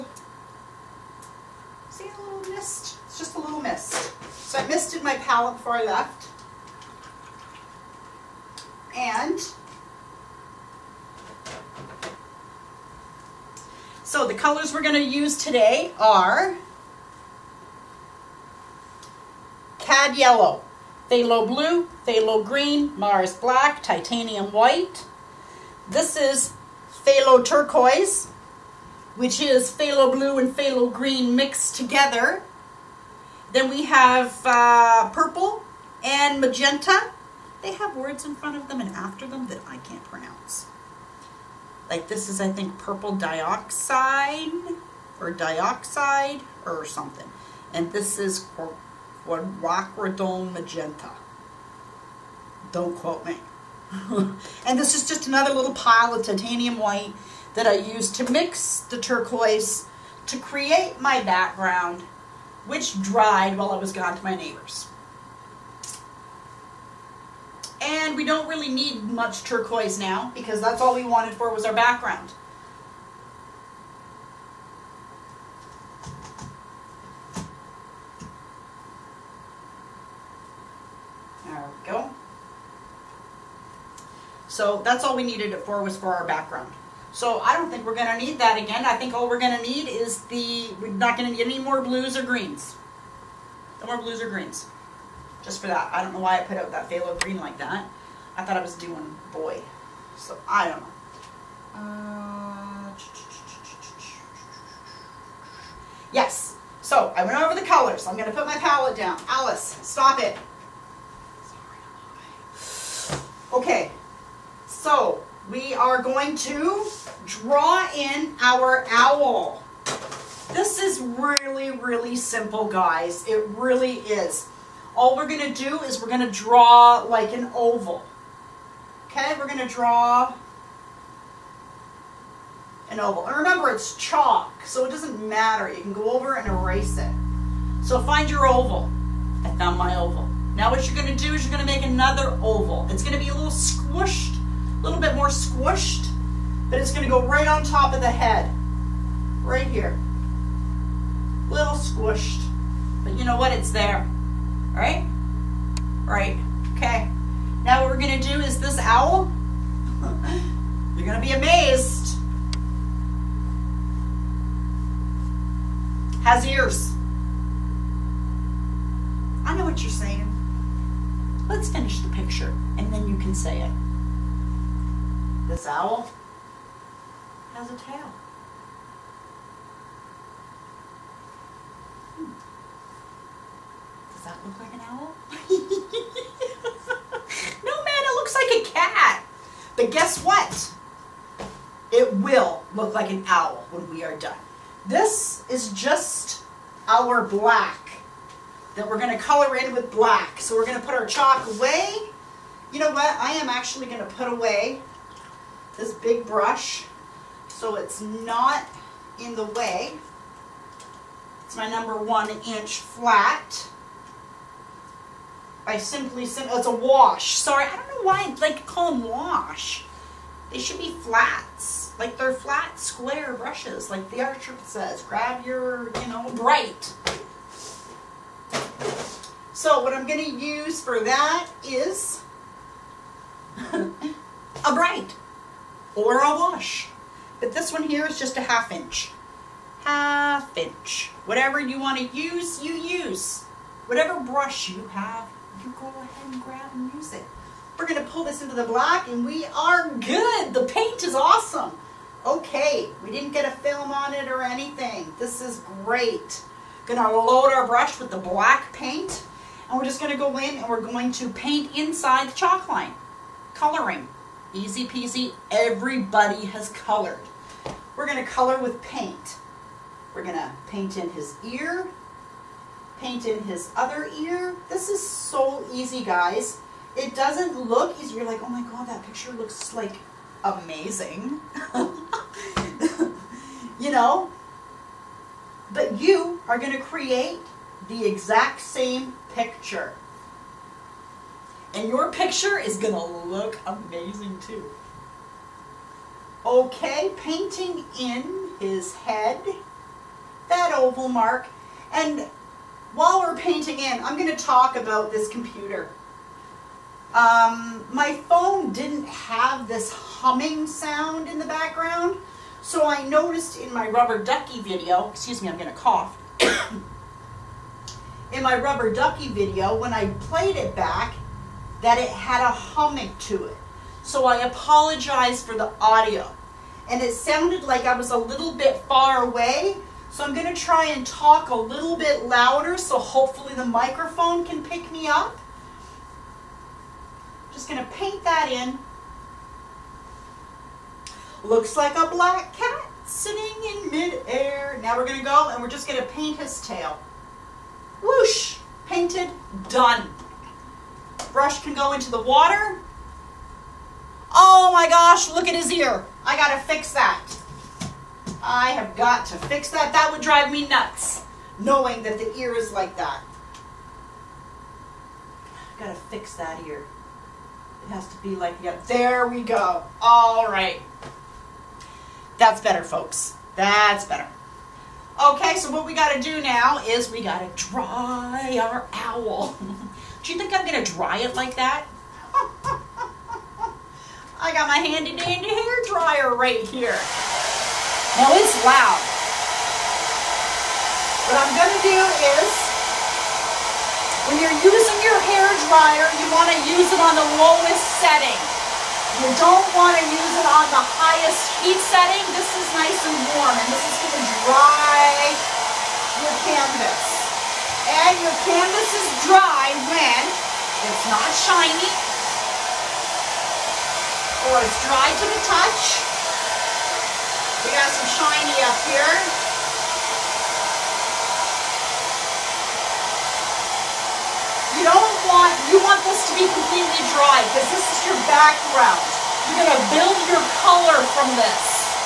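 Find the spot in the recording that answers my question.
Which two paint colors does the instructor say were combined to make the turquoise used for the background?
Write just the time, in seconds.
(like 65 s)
29 s.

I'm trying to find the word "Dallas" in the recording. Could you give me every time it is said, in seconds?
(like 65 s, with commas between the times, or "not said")
not said.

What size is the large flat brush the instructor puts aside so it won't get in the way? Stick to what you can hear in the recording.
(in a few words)
1 inch.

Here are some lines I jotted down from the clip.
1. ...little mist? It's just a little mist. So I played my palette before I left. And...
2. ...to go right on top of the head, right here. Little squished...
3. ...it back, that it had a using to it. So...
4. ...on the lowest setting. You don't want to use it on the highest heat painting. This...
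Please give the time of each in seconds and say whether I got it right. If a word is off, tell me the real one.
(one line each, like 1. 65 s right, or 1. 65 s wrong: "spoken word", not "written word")
1. 2 s wrong: "misted", not "played"
2. 147 s right
3. 320 s wrong: "humming", not "using"
4. 397 s wrong: "setting", not "painting".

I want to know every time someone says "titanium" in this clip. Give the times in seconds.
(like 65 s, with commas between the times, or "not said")
23 s, 56 s.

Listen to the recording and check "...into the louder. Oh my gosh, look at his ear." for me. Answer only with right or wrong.
wrong.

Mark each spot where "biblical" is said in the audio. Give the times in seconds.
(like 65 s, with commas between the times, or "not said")
not said.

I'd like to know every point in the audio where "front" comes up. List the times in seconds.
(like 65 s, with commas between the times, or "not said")
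38 s.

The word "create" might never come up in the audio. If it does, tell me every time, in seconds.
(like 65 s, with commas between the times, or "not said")
60 s, 286 s.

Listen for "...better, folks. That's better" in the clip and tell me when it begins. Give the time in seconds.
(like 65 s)
372 s.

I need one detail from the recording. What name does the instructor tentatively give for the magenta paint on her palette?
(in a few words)
Quadridone magenta.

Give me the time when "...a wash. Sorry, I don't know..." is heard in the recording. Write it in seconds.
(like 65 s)
216 s.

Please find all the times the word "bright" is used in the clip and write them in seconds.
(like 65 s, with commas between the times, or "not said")
226 s, 234 s.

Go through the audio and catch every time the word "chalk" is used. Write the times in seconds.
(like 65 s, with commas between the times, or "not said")
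133 s, 201 s, 262 s.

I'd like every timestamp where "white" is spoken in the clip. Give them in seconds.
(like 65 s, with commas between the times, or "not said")
24 s, 56 s.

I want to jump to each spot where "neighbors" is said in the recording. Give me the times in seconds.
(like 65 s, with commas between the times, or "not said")
64 s.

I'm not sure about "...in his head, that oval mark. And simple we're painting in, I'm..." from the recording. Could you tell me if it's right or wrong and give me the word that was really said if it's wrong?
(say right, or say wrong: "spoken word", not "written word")
wrong: "while", not "simple".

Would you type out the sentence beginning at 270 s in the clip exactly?
We're gonna paint in his ear, paint in his other ear.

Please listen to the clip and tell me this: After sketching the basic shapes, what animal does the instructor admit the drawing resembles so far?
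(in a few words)
A cat.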